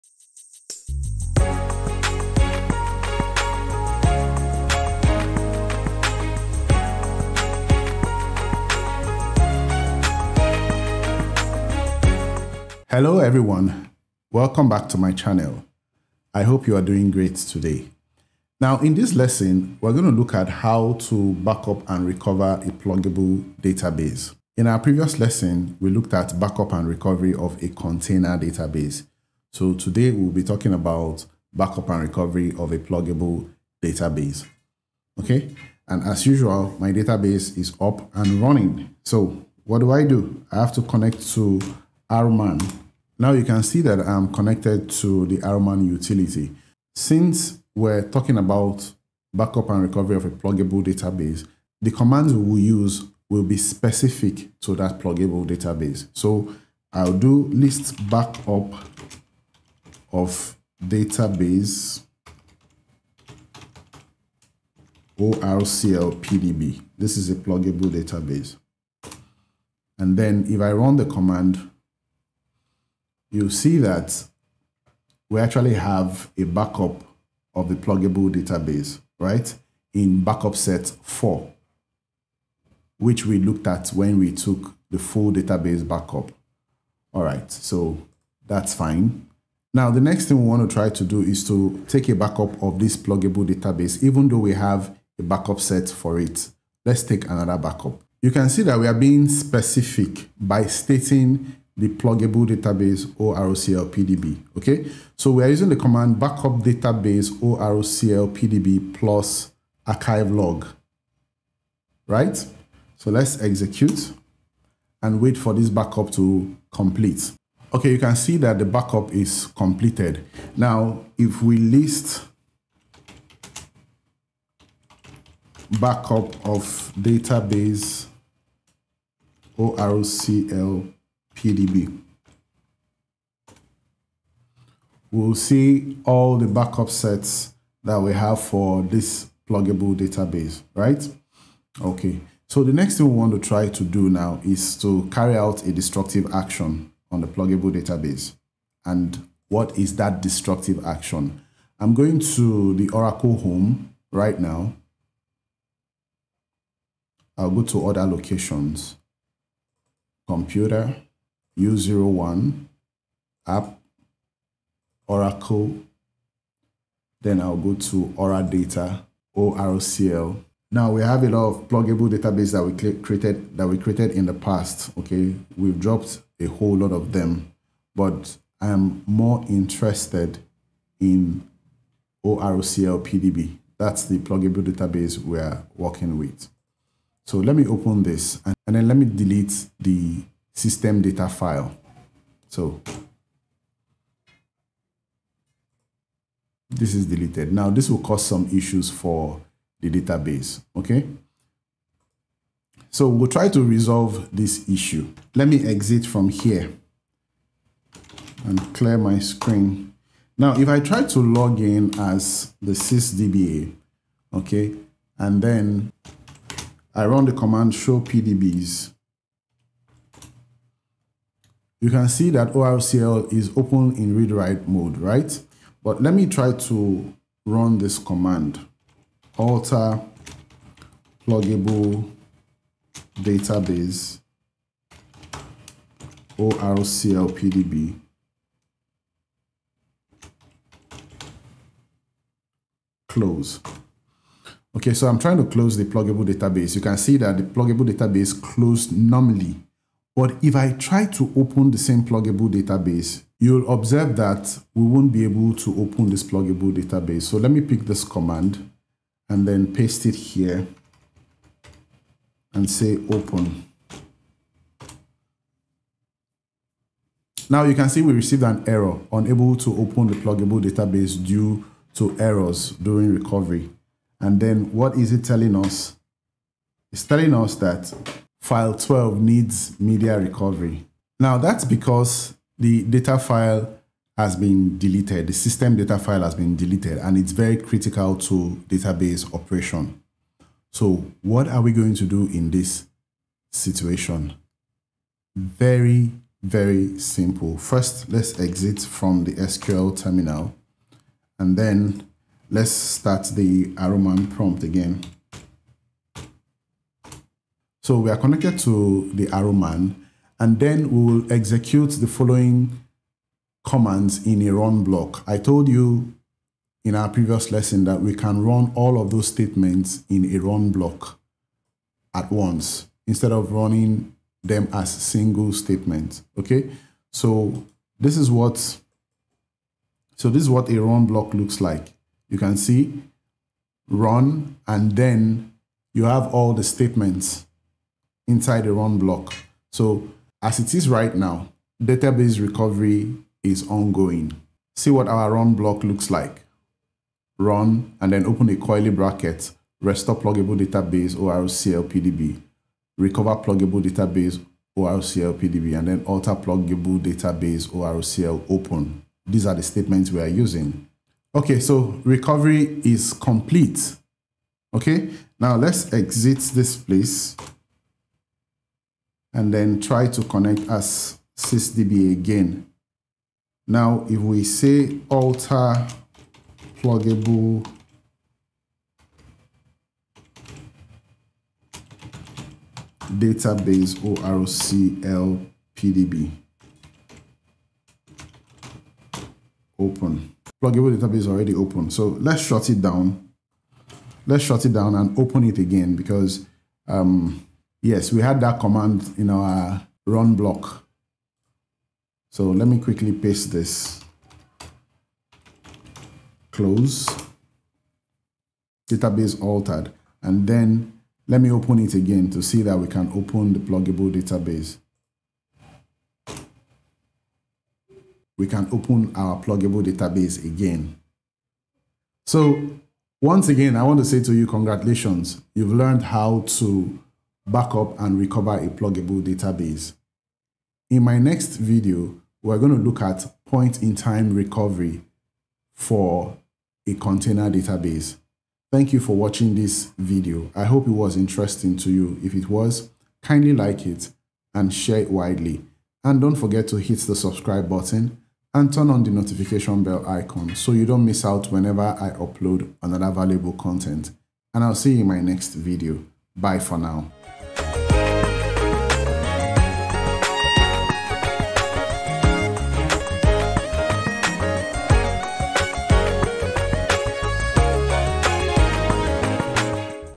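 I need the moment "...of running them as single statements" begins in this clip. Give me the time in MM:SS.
05:23.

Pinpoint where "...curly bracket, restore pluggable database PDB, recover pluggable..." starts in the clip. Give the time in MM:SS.
05:48.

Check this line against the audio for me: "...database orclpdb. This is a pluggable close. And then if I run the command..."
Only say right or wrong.
wrong.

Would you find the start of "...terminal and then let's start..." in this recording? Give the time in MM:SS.
04:59.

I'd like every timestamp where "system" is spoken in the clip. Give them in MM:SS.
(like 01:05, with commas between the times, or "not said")
03:10, 04:45.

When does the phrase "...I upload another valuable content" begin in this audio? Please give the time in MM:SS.
07:31.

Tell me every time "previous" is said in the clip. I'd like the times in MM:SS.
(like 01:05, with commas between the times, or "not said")
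00:24, 05:17.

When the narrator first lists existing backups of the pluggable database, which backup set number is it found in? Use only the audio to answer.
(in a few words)
4.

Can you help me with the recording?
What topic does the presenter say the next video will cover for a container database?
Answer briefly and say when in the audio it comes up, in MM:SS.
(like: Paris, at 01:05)
point-in-time recovery, at 07:13.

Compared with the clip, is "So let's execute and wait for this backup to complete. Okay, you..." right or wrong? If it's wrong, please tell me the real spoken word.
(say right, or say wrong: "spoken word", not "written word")
right.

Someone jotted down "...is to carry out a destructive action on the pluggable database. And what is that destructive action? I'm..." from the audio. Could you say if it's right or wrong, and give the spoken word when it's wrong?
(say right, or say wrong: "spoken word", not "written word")
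right.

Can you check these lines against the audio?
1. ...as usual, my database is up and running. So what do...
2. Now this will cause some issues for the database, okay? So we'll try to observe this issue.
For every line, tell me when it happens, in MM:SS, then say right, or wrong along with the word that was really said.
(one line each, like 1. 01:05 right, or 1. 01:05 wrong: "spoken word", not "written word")
1. 00:36 right
2. 03:17 wrong: "resolve", not "observe".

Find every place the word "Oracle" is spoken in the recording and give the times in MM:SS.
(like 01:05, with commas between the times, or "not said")
02:32, 02:45.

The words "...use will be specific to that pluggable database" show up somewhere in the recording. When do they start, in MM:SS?
00:52.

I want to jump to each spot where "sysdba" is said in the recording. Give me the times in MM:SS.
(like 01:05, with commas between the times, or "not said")
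03:32, 06:11.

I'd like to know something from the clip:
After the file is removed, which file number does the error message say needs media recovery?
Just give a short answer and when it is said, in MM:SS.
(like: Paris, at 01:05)
12, at 04:38.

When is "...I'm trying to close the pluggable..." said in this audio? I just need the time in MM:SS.
04:05.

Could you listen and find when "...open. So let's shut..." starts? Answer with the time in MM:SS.
06:31.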